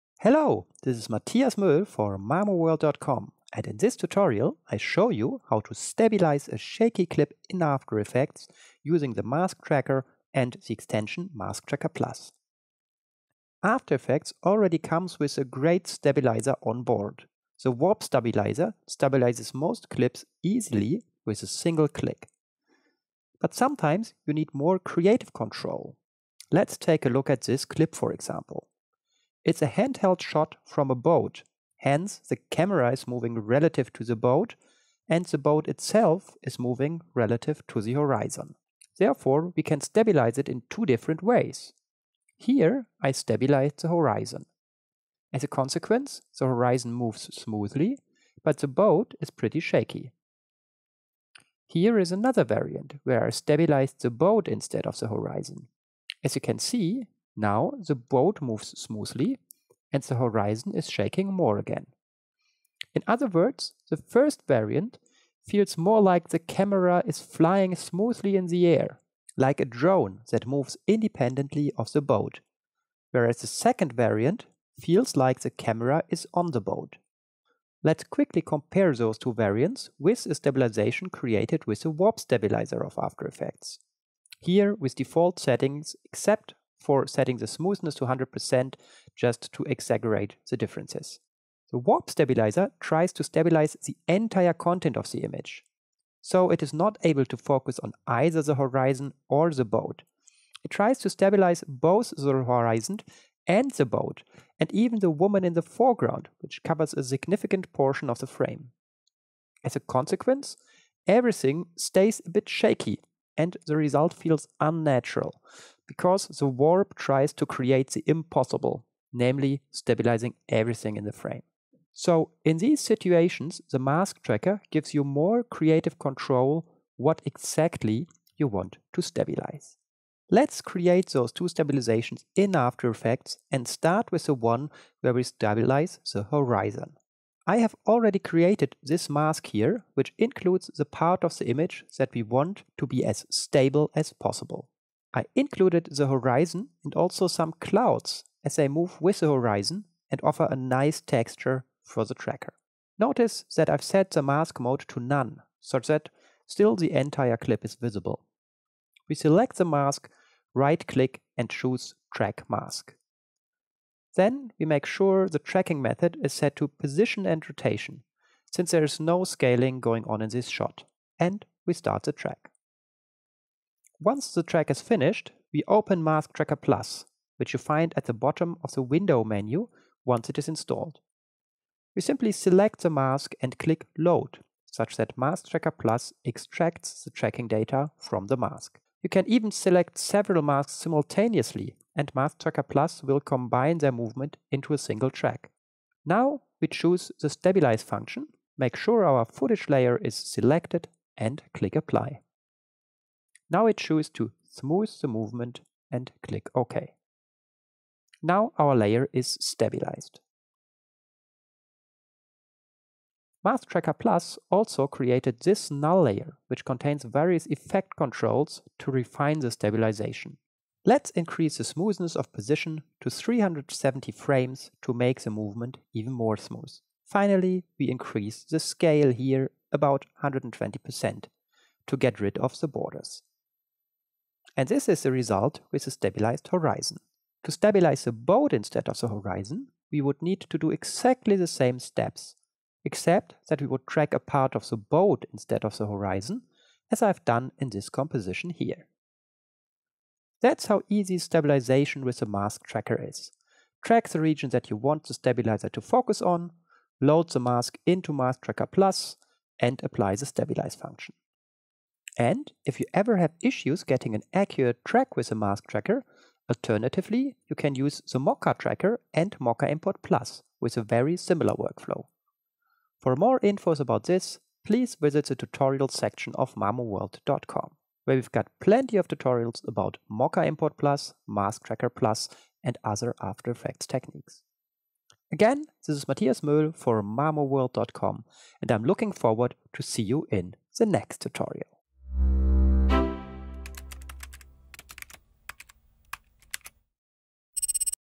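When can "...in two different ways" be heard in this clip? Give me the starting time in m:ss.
0:40.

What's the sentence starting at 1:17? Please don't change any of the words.
Let's quickly compare those two variants with a stabilization created with the warp stabilizer of After Effects.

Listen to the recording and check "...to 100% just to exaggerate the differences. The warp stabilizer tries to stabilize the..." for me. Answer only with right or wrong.
right.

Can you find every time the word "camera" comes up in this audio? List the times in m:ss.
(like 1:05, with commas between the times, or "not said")
0:32, 1:06, 1:15.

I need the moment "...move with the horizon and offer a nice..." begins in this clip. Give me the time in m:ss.
2:28.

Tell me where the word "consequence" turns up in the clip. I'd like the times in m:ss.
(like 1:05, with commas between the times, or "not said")
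0:45, 1:49.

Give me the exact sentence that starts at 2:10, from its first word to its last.
Let's create those two stabilizations in After Effects and start with the one where we stabilize the horizon.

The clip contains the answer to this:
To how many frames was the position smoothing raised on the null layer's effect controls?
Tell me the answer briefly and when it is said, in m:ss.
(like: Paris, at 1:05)
370, at 3:43.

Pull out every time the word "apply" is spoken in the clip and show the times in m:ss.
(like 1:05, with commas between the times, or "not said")
3:21, 4:19.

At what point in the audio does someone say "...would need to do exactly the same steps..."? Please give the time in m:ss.
4:00.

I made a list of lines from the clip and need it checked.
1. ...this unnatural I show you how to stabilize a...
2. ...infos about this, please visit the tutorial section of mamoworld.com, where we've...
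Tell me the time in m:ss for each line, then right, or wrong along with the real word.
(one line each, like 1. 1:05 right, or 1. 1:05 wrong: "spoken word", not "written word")
1. 0:03 wrong: "tutorial", not "unnatural"
2. 4:33 right.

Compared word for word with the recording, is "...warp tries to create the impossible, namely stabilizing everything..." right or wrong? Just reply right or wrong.
right.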